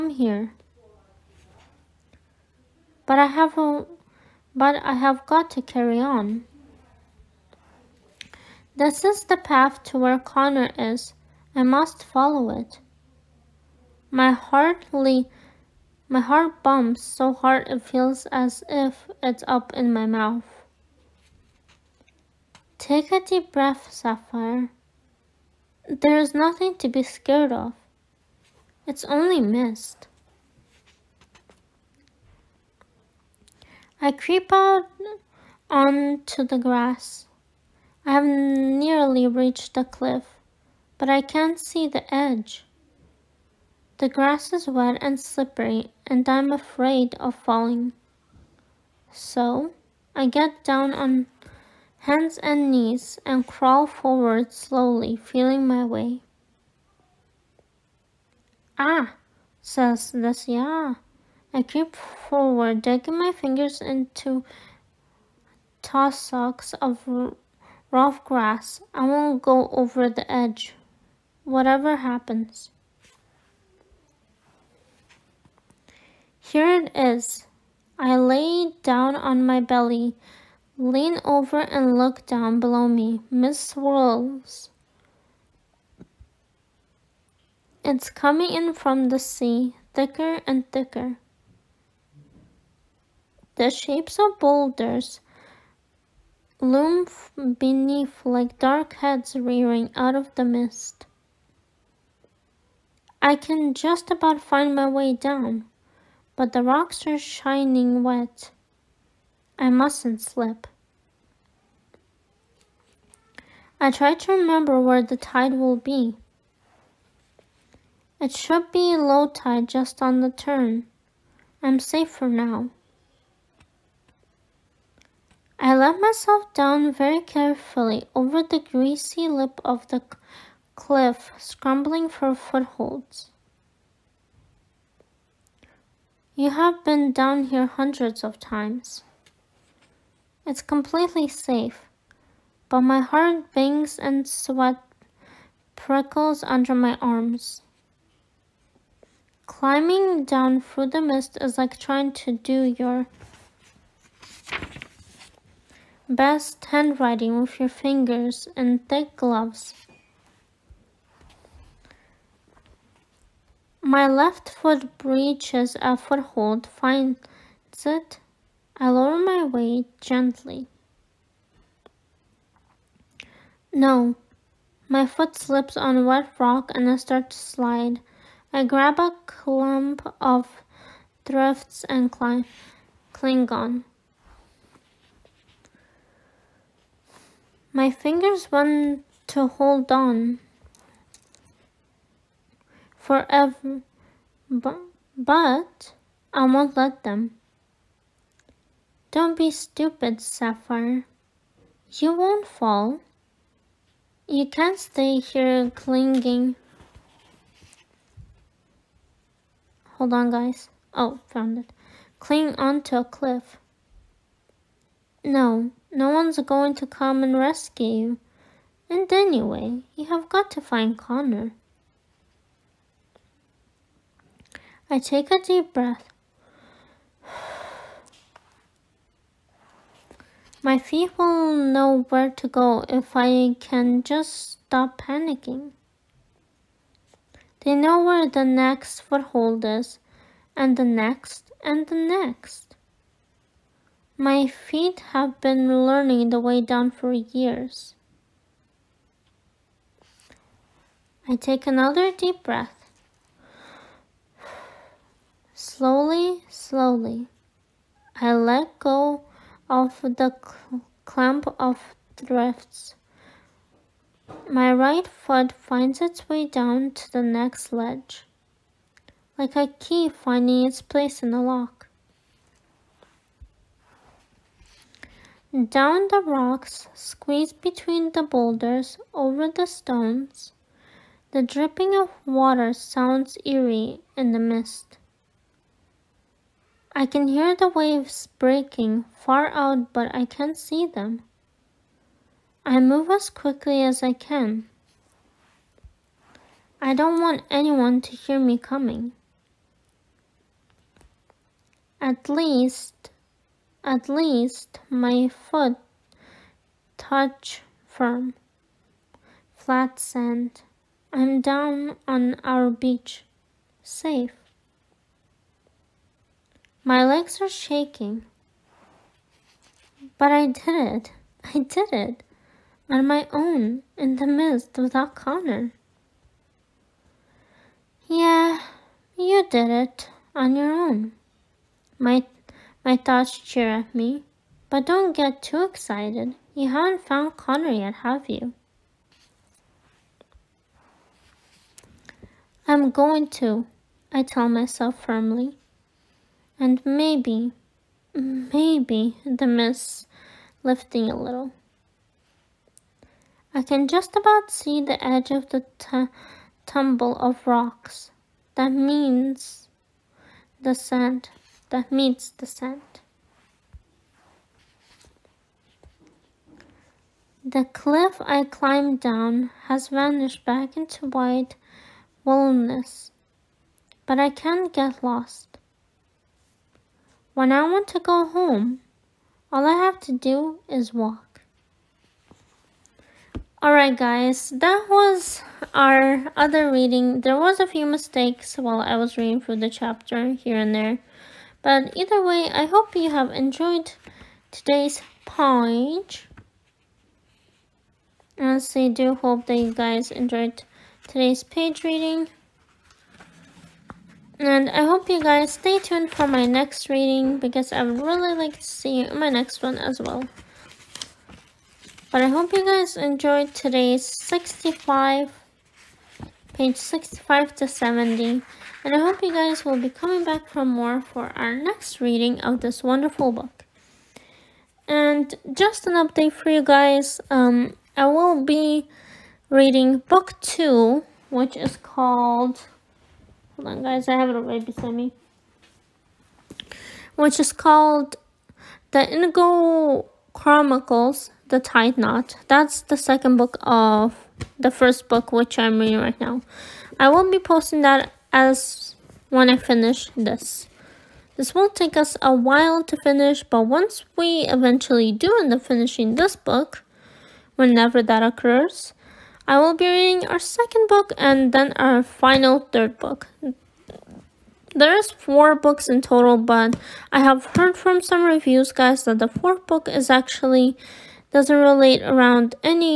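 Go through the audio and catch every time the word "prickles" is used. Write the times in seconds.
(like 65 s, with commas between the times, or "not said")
145 s.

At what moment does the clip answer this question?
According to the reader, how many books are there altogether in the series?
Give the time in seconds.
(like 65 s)
465 s.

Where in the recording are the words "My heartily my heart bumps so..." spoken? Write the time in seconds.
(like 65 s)
14 s.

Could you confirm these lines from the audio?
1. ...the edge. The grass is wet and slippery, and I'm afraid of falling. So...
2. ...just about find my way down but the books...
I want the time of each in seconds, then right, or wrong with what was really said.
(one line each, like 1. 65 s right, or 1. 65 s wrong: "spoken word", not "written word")
1. 41 s right
2. 103 s wrong: "rocks", not "books".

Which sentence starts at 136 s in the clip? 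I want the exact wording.
You have been down here hundreds of times.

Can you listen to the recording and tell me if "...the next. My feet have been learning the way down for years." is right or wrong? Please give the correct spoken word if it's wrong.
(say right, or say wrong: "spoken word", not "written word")
right.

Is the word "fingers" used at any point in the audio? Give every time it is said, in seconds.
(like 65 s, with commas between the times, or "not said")
63 s, 157 s, 187 s.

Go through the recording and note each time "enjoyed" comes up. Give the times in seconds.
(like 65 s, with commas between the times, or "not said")
393 s, 400 s, 412 s.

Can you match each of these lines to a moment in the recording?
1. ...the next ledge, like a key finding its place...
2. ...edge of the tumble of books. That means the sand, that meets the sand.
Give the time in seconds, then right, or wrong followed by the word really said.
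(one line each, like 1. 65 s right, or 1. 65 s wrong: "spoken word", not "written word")
1. 267 s right
2. 355 s wrong: "rocks", not "books".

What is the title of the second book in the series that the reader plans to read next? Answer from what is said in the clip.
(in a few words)
The Tide Knot.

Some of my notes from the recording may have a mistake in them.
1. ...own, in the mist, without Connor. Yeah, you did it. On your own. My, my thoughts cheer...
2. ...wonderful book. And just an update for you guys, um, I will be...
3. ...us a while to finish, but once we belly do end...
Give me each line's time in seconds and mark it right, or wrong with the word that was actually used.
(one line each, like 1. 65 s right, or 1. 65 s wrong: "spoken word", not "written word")
1. 323 s right
2. 422 s right
3. 451 s wrong: "eventually", not "belly".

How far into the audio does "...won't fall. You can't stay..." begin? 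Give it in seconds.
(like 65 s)
202 s.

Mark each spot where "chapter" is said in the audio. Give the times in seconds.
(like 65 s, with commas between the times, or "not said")
389 s.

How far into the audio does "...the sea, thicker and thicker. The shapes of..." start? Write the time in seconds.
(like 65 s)
89 s.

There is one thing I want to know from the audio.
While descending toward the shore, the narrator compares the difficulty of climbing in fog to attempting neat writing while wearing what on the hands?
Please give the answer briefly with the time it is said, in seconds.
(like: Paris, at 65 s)
thick gloves, at 158 s.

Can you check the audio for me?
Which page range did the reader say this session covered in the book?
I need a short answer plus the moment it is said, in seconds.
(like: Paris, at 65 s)
65 to 70, at 416 s.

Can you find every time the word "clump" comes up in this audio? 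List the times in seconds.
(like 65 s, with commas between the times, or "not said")
179 s, 261 s.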